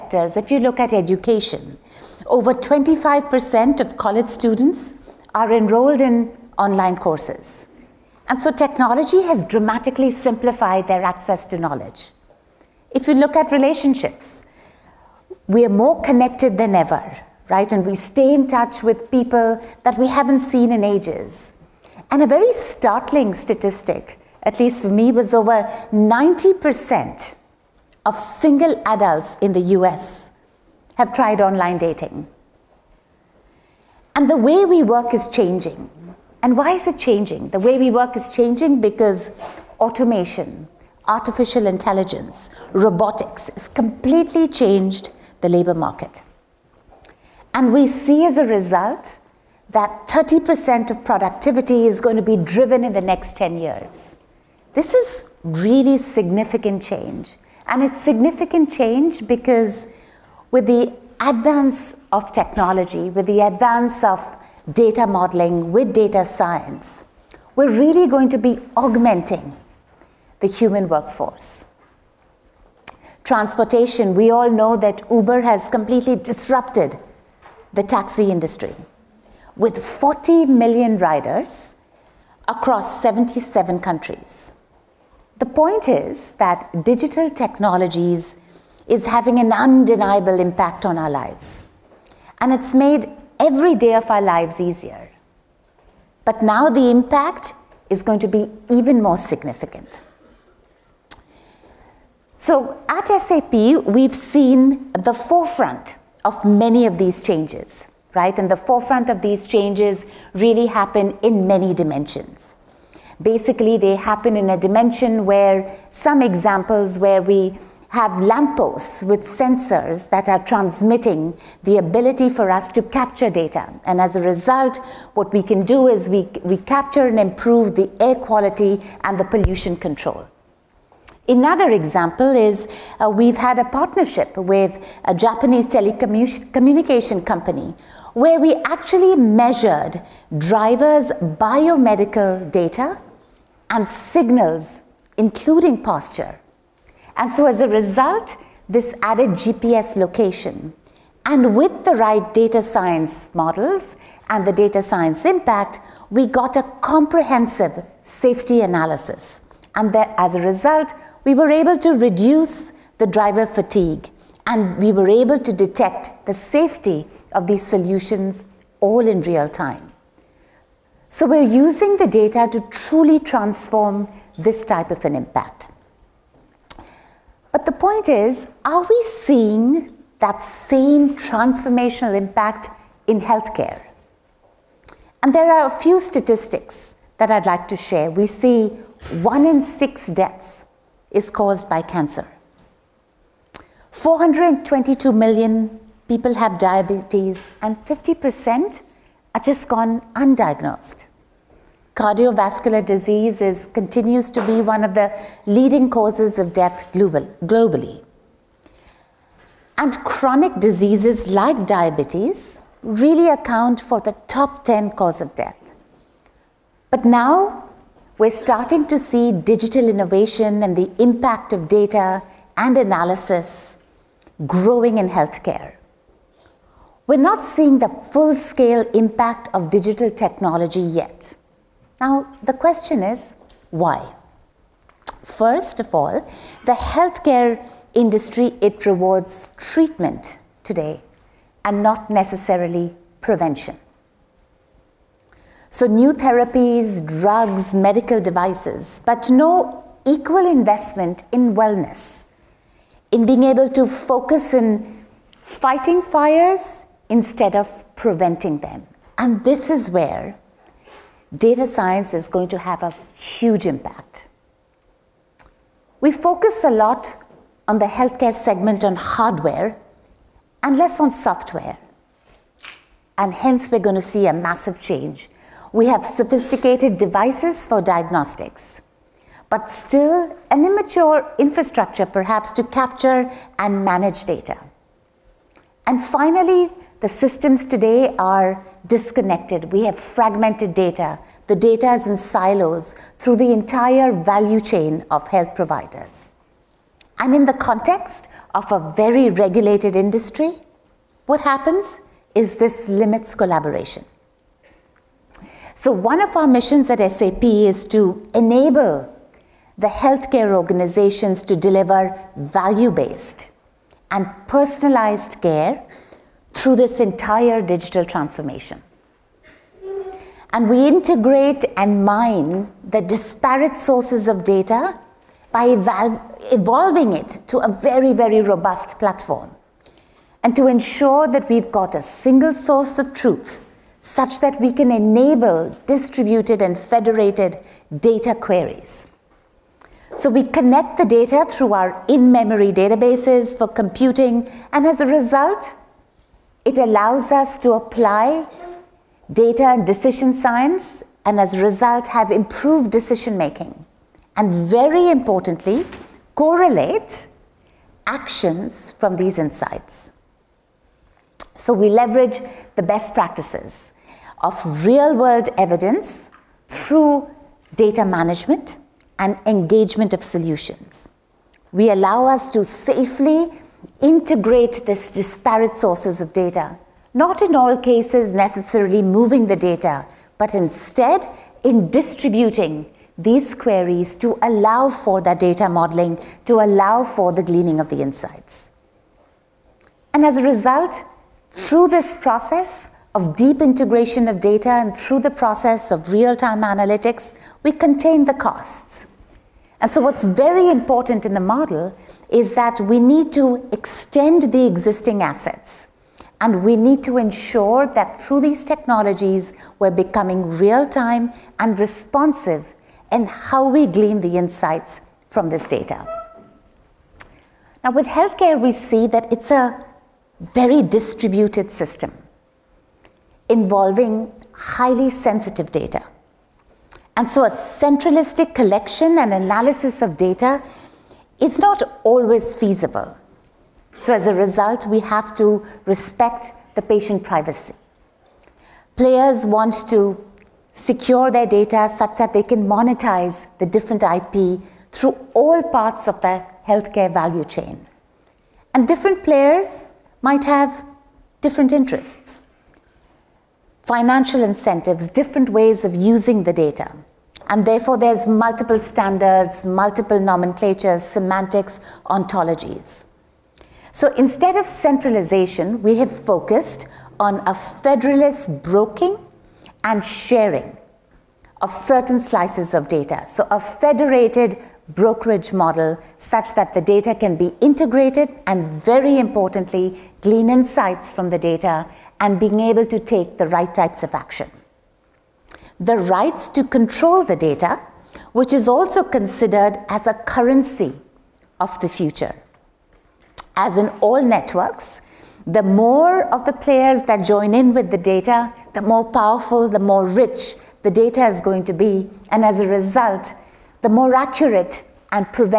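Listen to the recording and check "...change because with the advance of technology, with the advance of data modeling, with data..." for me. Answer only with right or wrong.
right.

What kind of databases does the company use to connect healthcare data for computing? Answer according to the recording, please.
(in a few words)
in-memory databases.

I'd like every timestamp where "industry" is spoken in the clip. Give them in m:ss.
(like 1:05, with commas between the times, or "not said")
1:18, 3:57, 4:59.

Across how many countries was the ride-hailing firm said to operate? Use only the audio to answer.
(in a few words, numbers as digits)
77.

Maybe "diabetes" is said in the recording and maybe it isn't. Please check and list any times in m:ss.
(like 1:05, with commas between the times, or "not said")
3:16, 3:31.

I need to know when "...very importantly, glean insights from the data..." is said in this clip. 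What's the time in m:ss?
7:58.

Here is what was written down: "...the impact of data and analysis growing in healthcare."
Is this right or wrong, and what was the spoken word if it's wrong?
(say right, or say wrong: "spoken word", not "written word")
right.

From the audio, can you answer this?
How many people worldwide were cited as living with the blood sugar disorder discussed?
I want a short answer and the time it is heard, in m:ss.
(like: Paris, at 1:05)
422 million, at 3:13.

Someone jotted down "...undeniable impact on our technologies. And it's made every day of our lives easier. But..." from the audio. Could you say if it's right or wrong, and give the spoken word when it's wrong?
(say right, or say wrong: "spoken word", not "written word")
wrong: "lives", not "technologies".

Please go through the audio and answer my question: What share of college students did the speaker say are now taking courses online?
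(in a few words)
over 25%.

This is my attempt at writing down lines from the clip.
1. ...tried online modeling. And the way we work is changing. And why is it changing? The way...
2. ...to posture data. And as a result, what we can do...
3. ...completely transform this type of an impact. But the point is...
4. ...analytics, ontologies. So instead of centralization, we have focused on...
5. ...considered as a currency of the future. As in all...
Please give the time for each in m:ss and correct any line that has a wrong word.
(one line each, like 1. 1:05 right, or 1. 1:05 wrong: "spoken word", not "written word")
1. 0:31 wrong: "dating", not "modeling"
2. 2:02 wrong: "capture", not "posture"
3. 2:52 wrong: "truly", not "completely"
4. 7:41 wrong: "semantics", not "analytics"
5. 8:09 right.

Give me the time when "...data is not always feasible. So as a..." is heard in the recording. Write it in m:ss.
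7:10.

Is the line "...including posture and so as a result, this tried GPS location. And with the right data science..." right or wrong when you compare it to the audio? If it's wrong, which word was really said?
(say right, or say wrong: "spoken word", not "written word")
wrong: "added", not "tried".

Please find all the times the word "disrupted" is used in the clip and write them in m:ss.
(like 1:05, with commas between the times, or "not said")
1:16.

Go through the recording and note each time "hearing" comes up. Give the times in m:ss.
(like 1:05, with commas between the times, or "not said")
not said.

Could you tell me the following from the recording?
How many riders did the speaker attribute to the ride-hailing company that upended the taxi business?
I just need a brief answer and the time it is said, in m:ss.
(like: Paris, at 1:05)
40 million, at 1:19.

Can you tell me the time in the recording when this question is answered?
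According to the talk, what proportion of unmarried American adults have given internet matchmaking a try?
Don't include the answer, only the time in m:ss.
0:25.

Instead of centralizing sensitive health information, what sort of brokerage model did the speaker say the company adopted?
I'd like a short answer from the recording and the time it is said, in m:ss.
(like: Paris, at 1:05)
federated brokerage model, at 7:53.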